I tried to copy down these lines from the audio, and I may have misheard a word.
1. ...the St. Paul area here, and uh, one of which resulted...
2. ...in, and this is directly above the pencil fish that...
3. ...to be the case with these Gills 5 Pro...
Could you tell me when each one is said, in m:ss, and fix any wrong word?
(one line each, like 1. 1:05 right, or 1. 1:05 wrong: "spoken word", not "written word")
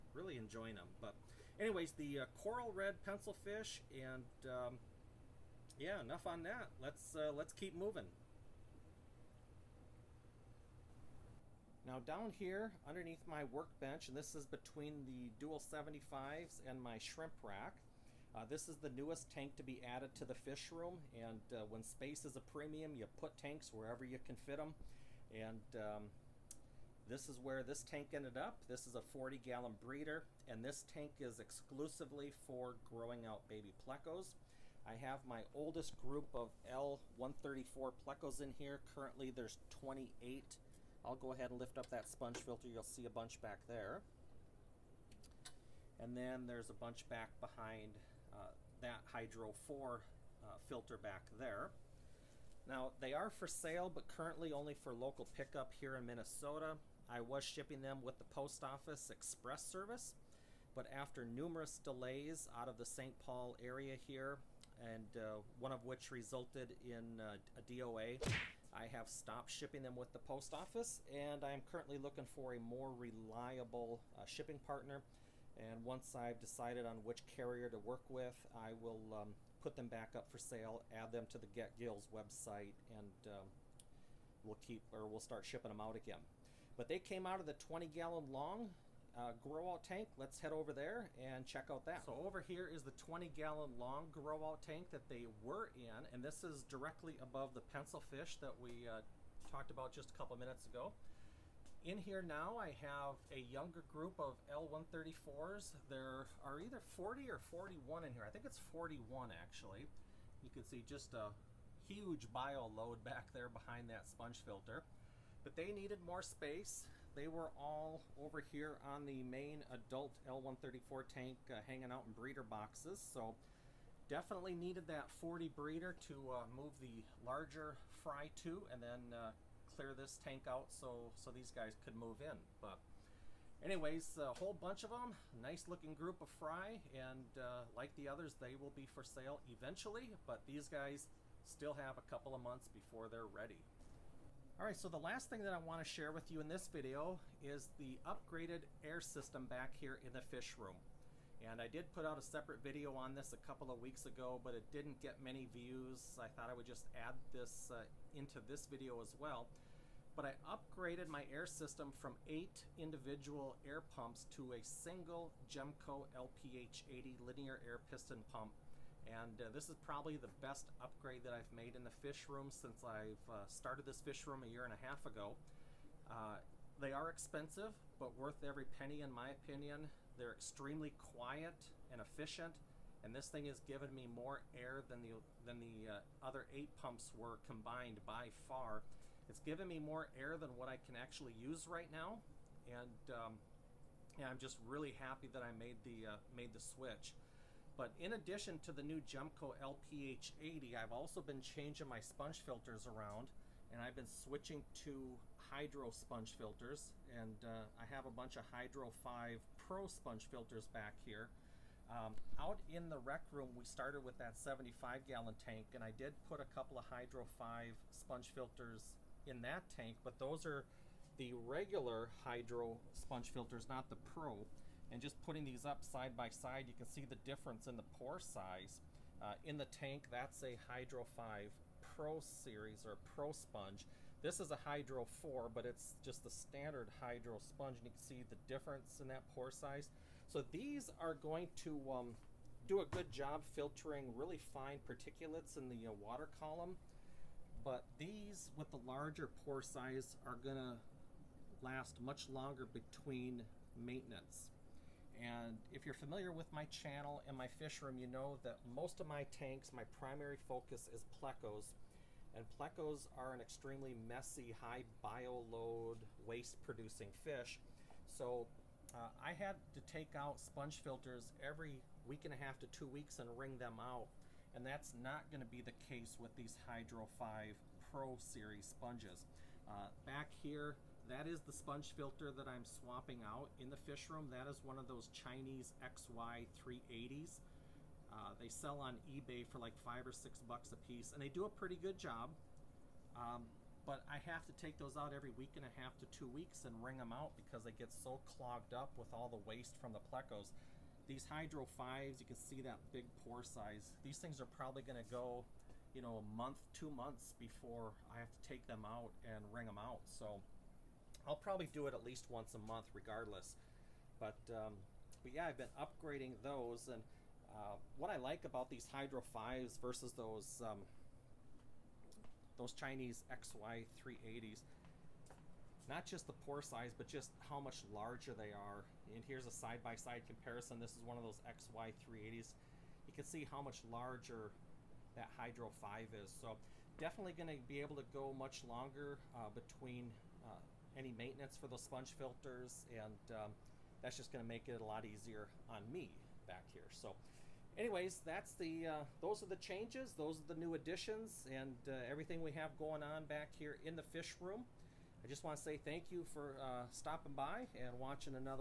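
1. 1:02 right
2. 1:35 right
3. 4:35 wrong: "Hydro", not "Gills".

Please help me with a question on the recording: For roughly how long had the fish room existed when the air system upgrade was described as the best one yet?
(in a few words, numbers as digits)
a year and a half.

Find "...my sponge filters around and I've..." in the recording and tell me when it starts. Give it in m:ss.
3:21.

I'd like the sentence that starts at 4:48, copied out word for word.
Uh, they sell on eBay for like five or six bucks a piece, and they do a pretty good job.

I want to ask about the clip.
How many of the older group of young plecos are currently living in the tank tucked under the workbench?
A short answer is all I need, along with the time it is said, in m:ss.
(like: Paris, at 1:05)
28, at 0:39.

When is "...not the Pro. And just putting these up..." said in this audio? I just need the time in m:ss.
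3:43.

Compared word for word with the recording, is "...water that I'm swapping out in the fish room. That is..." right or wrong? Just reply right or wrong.
wrong.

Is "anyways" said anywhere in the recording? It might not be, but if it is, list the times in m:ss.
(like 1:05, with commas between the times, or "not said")
0:01, 2:13, 5:47.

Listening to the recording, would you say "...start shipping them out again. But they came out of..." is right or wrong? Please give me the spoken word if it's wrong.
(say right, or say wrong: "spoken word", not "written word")
right.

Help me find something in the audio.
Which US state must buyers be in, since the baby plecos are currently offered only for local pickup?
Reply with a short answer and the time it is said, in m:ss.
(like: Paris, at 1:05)
Minnesota, at 0:56.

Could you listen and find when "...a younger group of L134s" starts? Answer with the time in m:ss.
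1:43.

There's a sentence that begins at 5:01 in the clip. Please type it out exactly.
These Hydro 5s, you can see that big pore size.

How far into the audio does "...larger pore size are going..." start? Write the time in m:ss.
4:08.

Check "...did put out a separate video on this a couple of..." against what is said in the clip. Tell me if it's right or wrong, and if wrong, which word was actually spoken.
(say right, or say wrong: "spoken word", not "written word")
right.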